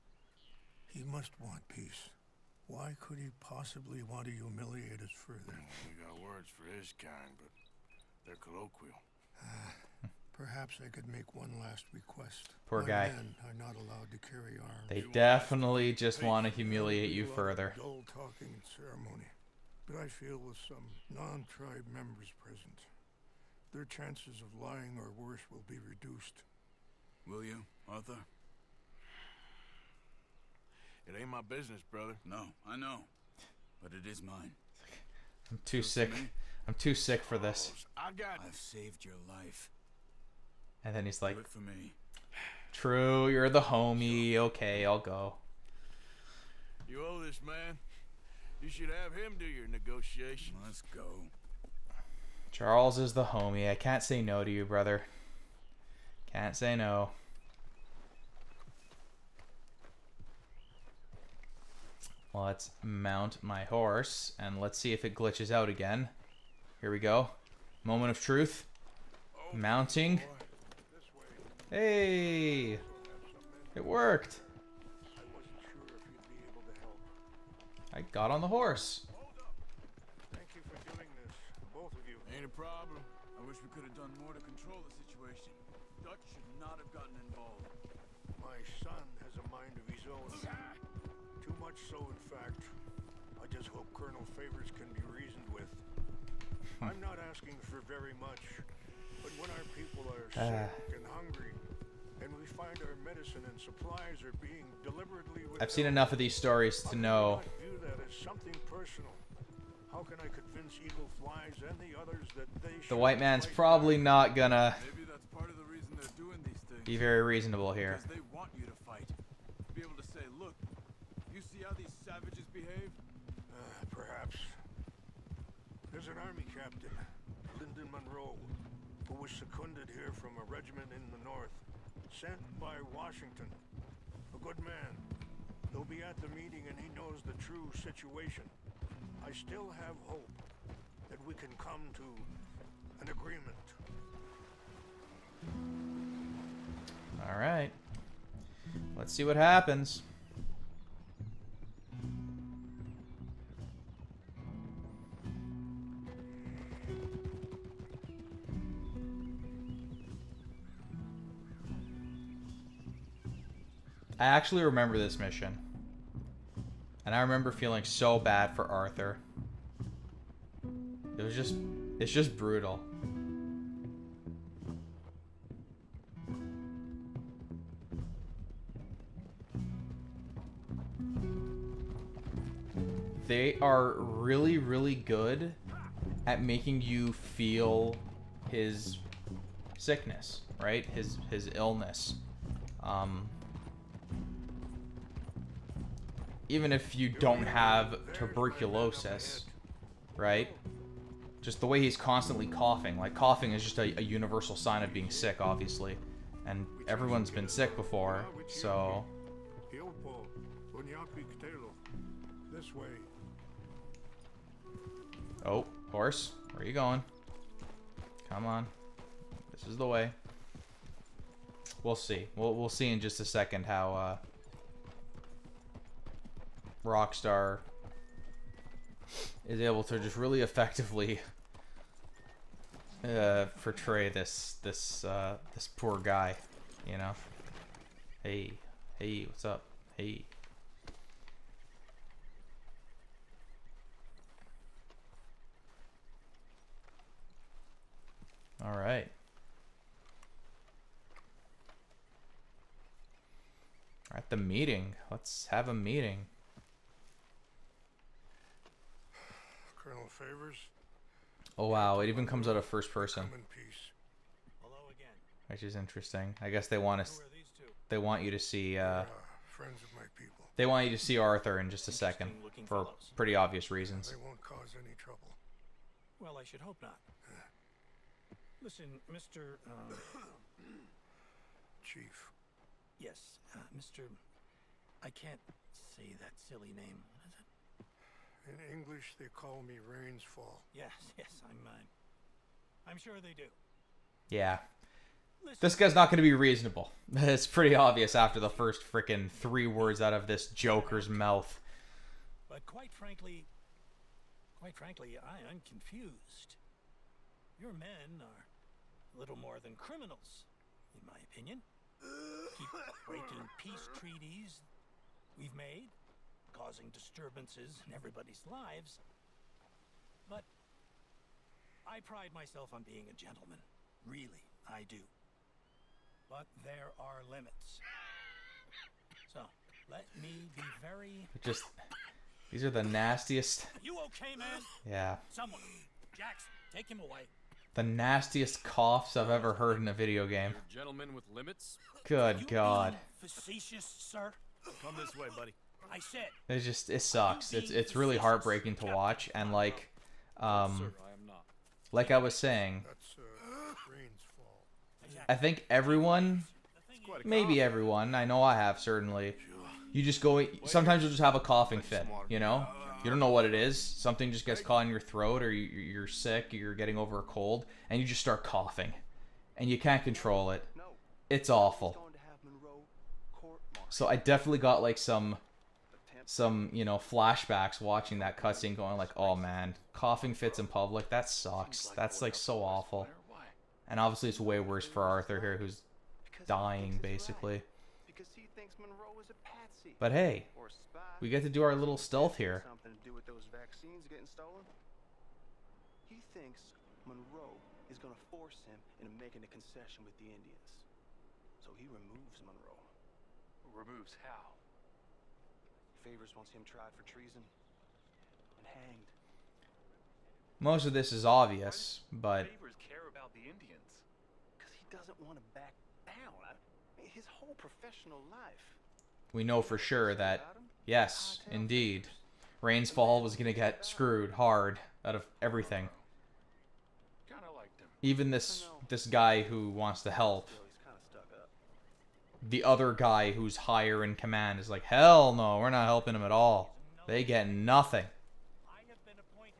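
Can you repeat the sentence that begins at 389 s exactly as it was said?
But hey, we get to do our little stealth here.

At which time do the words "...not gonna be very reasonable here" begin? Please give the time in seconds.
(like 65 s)
113 s.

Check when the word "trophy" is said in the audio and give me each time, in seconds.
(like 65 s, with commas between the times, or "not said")
not said.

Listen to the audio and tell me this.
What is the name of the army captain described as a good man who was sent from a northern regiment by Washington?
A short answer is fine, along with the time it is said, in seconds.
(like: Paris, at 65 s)
Lyndon Monroe, at 127 s.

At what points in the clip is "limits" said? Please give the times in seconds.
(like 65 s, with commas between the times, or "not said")
327 s, 341 s.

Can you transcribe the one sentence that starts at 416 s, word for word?
I mean, his whole professional life.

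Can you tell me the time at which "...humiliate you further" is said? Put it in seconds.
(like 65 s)
16 s.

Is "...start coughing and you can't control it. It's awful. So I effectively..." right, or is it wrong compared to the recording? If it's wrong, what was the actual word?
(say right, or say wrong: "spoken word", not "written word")
wrong: "definitely", not "effectively".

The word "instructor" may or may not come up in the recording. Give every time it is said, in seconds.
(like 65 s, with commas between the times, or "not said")
not said.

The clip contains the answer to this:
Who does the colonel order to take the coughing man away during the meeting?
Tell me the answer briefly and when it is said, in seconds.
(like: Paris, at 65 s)
Jackson, at 336 s.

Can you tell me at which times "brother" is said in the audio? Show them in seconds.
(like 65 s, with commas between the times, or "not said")
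31 s, 54 s.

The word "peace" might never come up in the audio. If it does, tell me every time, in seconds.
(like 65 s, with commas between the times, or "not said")
1 s, 313 s.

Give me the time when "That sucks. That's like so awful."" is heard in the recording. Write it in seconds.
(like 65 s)
381 s.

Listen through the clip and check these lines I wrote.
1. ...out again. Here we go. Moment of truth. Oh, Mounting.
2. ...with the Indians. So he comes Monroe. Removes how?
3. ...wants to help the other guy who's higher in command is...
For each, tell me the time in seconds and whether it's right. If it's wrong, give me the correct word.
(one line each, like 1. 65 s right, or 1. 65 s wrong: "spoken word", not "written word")
1. 65 s right
2. 400 s wrong: "removes", not "comes"
3. 429 s right.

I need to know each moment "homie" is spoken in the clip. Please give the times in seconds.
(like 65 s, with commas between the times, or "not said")
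43 s, 53 s.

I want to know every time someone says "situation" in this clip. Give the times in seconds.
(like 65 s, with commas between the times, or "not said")
84 s, 137 s.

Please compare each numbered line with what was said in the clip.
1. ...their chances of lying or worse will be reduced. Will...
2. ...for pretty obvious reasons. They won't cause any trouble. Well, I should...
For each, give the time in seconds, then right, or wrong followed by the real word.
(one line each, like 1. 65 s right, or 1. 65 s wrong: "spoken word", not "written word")
1. 23 s right
2. 272 s right.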